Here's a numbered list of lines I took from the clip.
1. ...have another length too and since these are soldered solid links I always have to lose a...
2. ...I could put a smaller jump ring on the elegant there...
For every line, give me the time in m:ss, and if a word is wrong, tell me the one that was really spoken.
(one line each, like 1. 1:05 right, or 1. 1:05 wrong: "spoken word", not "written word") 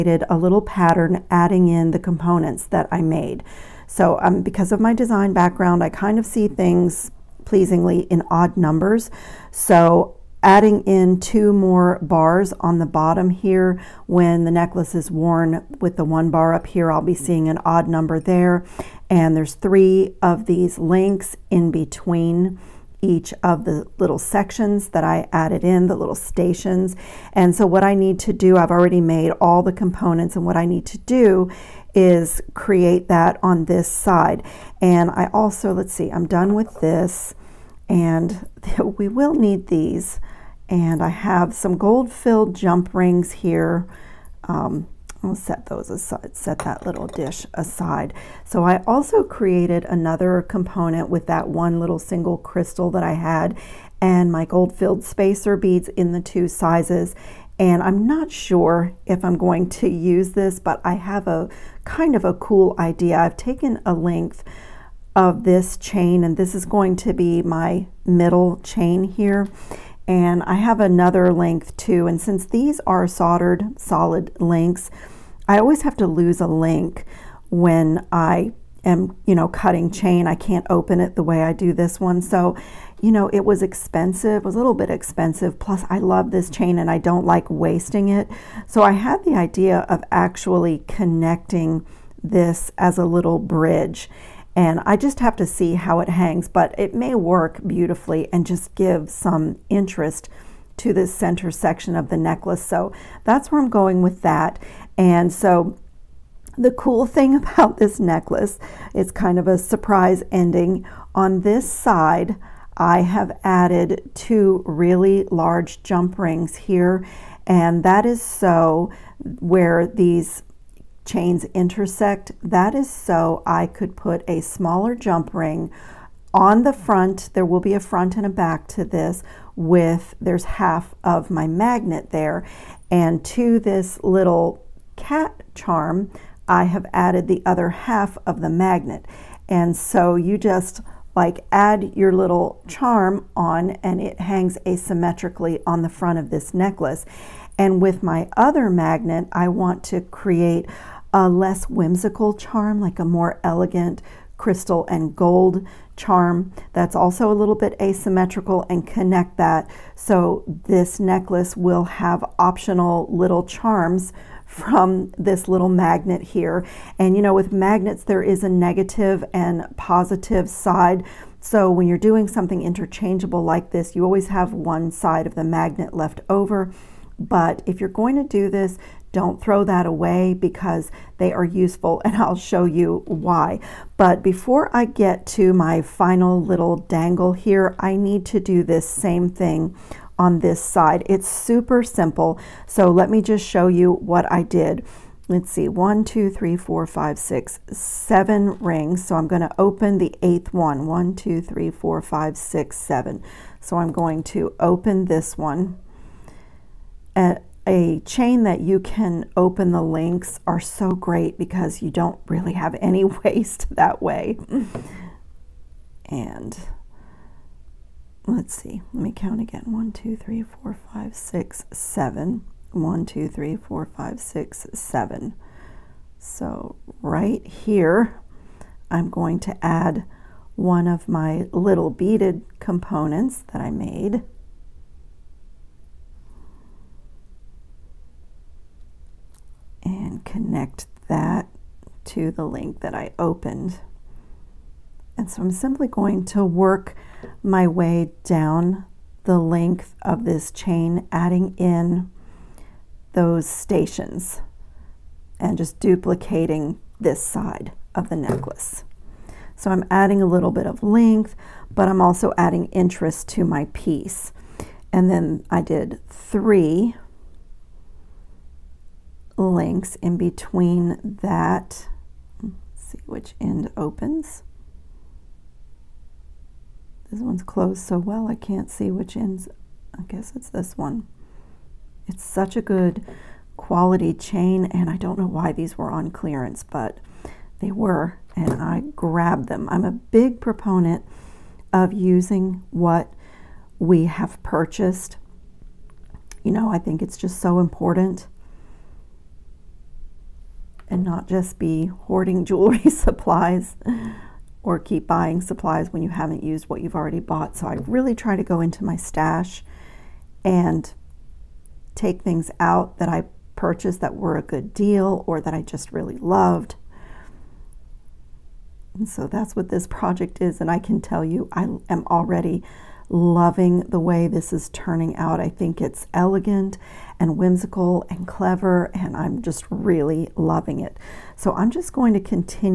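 1. 1:10 right
2. 2:03 wrong: "front", not "elegant".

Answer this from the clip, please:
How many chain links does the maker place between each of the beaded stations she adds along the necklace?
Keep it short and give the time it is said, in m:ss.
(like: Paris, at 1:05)
3, at 0:19.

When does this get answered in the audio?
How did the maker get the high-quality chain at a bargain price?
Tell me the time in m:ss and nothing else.
4:45.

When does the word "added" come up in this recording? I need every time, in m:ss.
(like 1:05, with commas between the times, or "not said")
0:25, 1:53, 2:16.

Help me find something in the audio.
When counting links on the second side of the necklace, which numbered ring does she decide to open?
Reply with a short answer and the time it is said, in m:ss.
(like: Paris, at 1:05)
8th, at 3:20.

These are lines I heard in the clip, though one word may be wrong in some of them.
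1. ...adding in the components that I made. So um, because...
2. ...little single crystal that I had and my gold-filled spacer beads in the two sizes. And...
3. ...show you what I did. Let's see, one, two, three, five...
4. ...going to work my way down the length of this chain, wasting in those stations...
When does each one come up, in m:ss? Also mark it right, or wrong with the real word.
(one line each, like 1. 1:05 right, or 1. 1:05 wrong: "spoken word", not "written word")
1. 0:01 right
2. 0:51 right
3. 3:13 wrong: "four", not "five"
4. 4:05 wrong: "adding", not "wasting".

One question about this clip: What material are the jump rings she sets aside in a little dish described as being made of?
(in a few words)
Gold filled.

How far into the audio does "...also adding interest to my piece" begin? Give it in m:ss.
4:22.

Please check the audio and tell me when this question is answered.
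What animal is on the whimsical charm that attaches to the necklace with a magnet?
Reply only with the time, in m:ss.
2:14.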